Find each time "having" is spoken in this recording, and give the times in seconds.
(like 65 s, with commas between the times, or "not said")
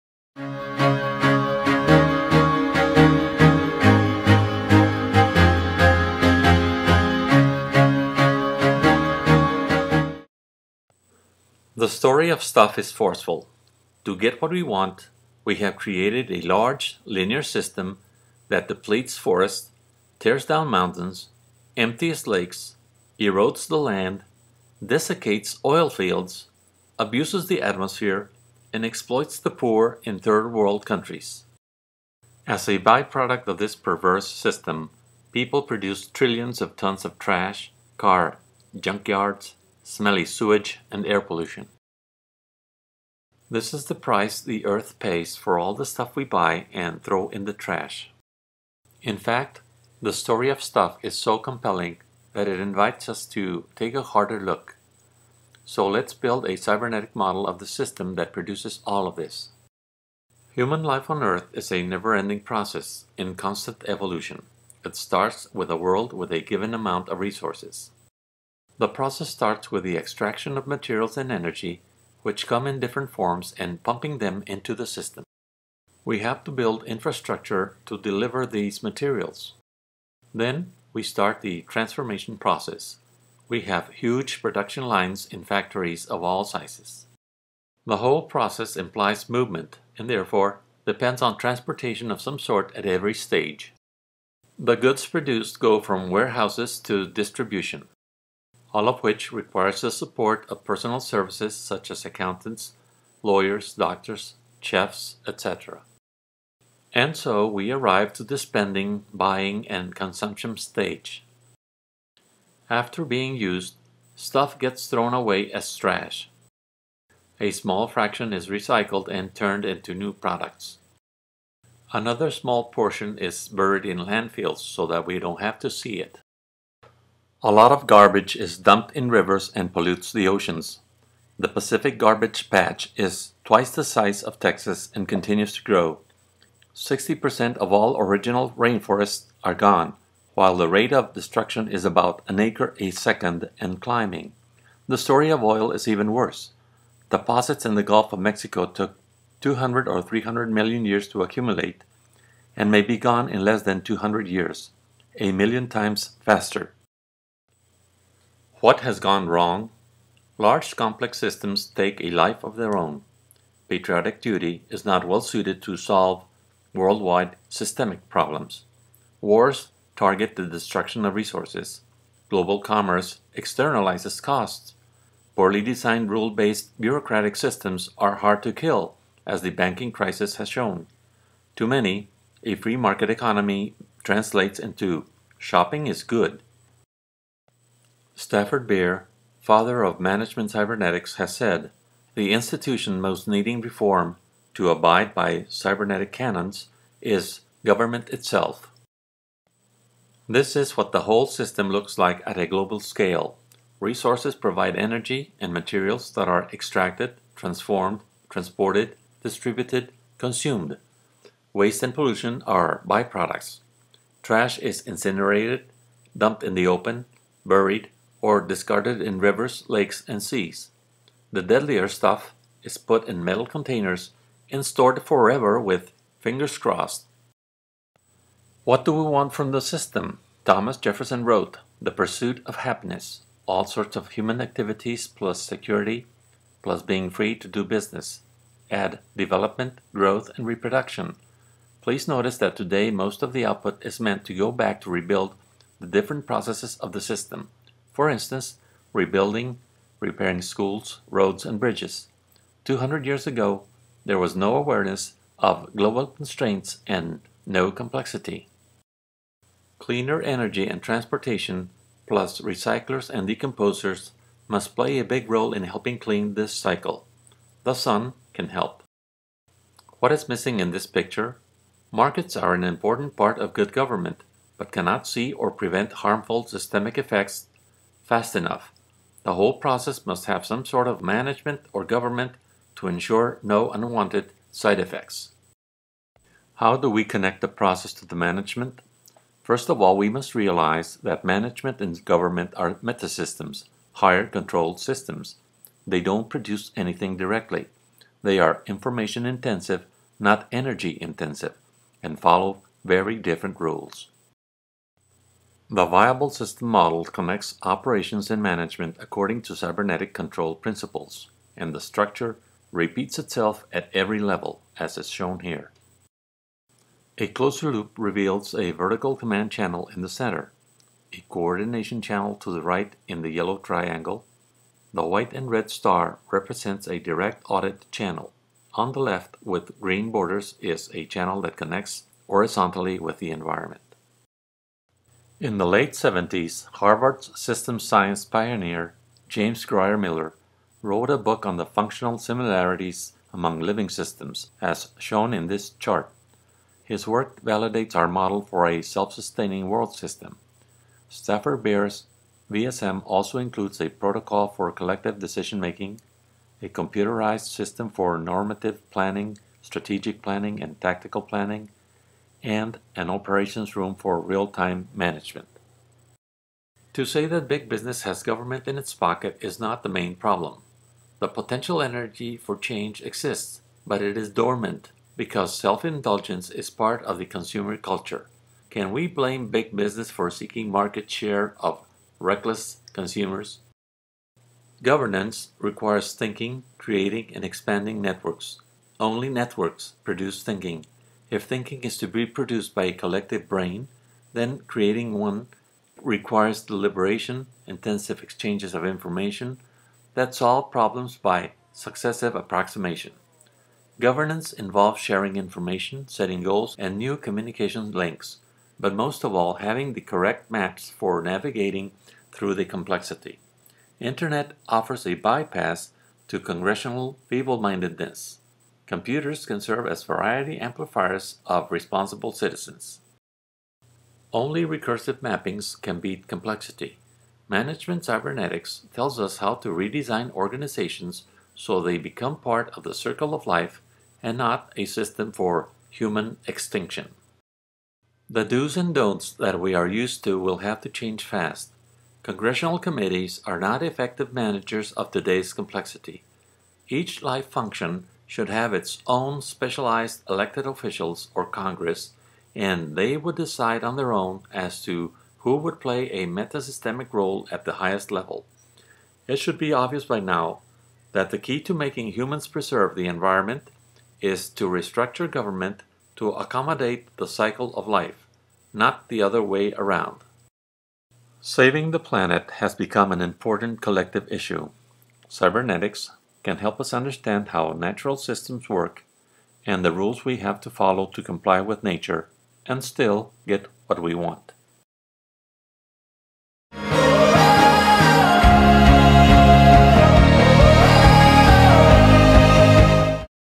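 409 s.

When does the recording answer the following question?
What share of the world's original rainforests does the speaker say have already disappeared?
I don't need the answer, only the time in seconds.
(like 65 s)
136 s.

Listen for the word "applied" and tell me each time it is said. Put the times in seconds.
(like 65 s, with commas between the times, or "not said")
not said.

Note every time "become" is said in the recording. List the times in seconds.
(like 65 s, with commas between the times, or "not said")
431 s, 472 s.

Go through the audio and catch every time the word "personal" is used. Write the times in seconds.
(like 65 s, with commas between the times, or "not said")
100 s.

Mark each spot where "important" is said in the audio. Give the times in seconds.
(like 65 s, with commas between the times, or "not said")
272 s, 473 s.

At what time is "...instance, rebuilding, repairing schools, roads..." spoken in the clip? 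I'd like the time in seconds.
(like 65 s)
248 s.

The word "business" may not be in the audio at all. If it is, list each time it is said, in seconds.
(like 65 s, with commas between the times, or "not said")
237 s, 367 s, 379 s.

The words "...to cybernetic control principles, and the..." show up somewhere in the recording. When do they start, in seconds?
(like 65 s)
309 s.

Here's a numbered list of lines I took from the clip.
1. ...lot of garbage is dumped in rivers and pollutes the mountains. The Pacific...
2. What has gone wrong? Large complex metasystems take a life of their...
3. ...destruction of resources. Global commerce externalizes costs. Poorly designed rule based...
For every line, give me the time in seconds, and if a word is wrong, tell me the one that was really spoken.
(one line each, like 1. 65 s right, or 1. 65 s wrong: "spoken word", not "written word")
1. 127 s wrong: "oceans", not "mountains"
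2. 158 s wrong: "systems", not "metasystems"
3. 170 s right.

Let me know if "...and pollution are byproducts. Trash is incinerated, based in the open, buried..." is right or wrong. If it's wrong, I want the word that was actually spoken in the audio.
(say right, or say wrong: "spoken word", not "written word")
wrong: "dumped", not "based".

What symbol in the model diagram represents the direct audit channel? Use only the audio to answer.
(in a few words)
White and red star.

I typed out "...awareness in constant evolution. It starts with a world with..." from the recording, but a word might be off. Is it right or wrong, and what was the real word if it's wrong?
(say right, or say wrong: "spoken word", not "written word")
wrong: "process", not "awareness".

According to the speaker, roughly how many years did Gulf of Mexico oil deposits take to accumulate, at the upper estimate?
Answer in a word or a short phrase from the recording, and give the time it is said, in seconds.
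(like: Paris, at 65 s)
300 million years, at 150 s.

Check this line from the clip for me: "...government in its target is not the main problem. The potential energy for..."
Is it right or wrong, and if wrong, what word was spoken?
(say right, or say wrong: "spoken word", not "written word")
wrong: "pocket", not "target".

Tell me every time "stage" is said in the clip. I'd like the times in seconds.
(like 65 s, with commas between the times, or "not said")
93 s, 110 s.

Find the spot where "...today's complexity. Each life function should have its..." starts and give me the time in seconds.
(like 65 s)
445 s.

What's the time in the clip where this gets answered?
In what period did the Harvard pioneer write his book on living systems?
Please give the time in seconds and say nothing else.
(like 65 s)
335 s.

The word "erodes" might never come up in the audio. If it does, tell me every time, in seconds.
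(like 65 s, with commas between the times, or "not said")
23 s.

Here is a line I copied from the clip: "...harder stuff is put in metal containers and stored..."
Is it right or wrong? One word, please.
wrong.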